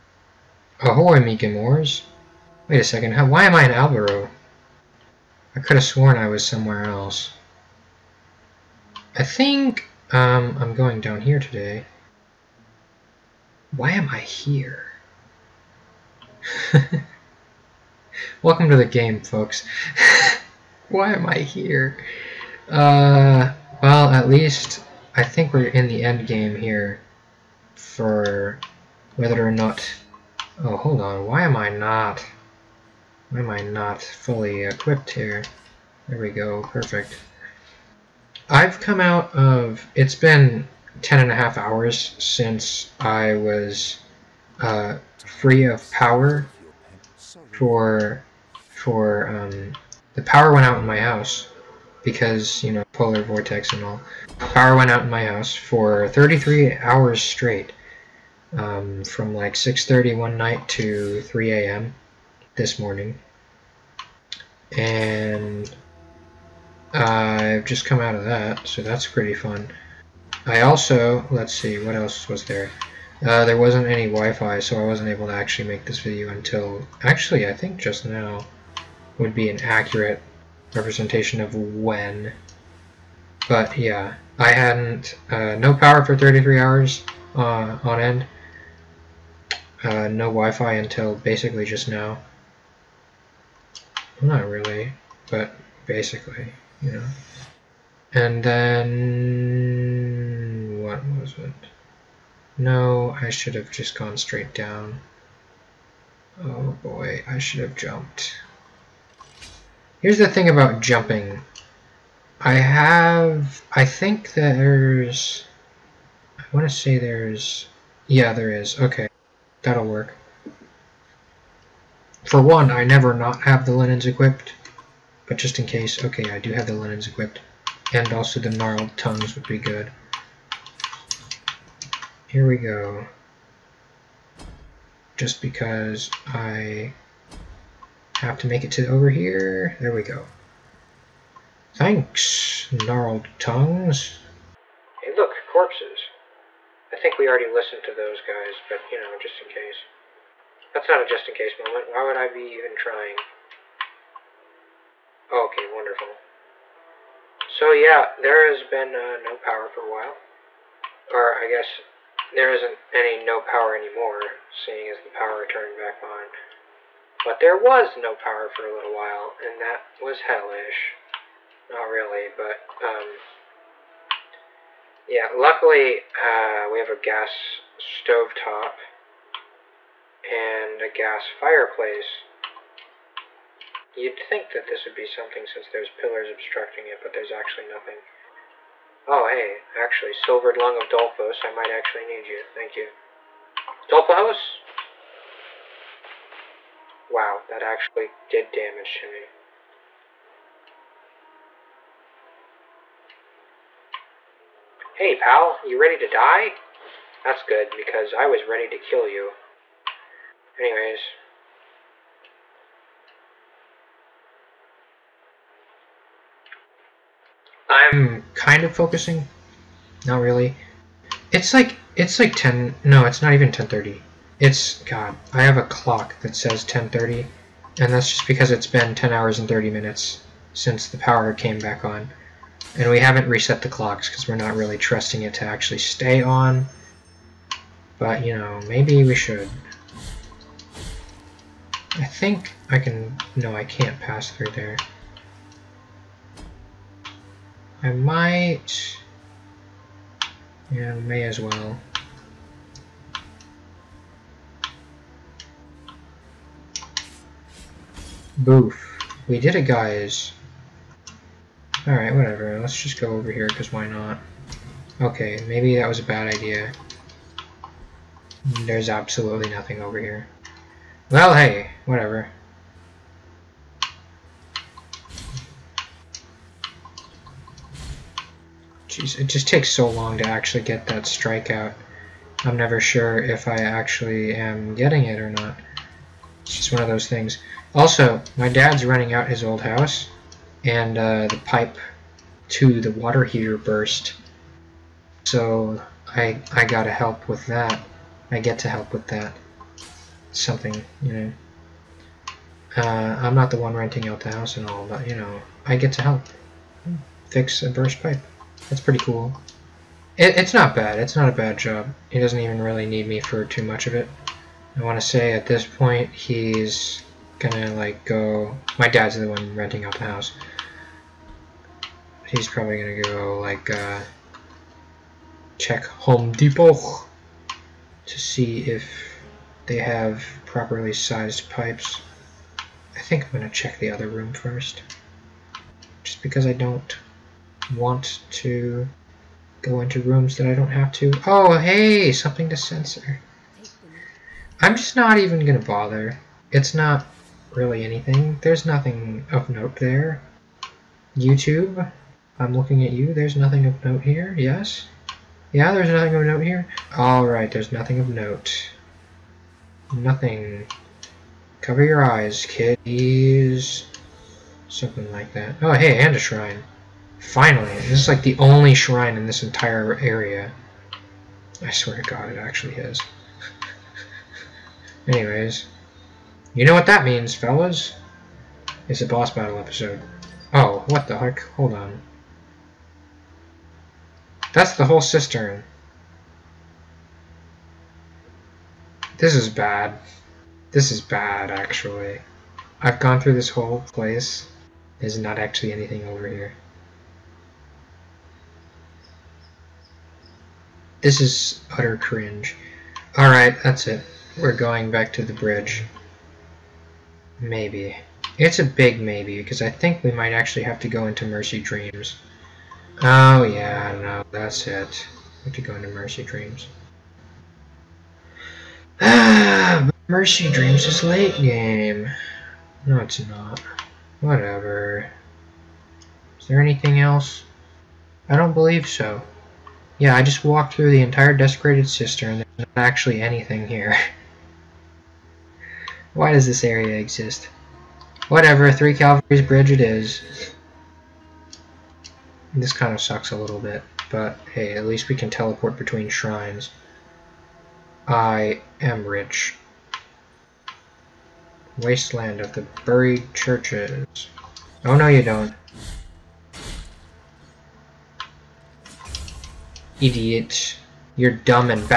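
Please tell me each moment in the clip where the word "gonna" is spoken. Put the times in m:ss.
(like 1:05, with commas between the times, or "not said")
5:17, 5:22, 5:33, 5:45.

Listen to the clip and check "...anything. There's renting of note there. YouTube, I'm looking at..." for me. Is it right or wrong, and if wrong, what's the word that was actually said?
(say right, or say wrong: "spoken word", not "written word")
wrong: "nothing", not "renting".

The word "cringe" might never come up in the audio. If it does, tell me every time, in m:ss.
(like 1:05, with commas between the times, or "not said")
6:41.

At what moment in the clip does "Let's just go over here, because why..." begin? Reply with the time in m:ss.
4:22.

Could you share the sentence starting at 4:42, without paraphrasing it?
I'm never sure if I actually am getting it or not.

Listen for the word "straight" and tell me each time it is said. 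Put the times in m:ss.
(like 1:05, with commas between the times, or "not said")
0:57, 1:44.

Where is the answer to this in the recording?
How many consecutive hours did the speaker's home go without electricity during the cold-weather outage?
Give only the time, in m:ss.
0:56.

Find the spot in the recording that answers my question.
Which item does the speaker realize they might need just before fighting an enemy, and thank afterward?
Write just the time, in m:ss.
3:10.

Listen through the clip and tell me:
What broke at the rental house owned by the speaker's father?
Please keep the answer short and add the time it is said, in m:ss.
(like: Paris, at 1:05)
the pipe to the water heater, at 4:51.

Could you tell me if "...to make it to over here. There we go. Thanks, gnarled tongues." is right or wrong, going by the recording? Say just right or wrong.
right.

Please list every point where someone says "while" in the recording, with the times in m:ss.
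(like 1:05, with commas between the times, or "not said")
2:39, 2:48.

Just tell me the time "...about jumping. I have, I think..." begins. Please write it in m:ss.
1:50.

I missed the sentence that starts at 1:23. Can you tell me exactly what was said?
But yeah, I hadn't, uh, no power for 33 hours uh, on end, uh, no Wi-Fi until basically just now.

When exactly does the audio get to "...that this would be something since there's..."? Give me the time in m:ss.
3:04.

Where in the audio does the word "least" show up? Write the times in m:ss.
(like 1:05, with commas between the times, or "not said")
0:24, 7:24.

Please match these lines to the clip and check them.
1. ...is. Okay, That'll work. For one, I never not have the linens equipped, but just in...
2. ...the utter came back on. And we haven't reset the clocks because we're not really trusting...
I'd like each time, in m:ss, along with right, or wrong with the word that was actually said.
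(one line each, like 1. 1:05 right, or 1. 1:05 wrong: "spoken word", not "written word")
1. 1:58 right
2. 3:50 wrong: "power", not "utter".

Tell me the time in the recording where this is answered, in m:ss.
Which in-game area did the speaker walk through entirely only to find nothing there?
7:11.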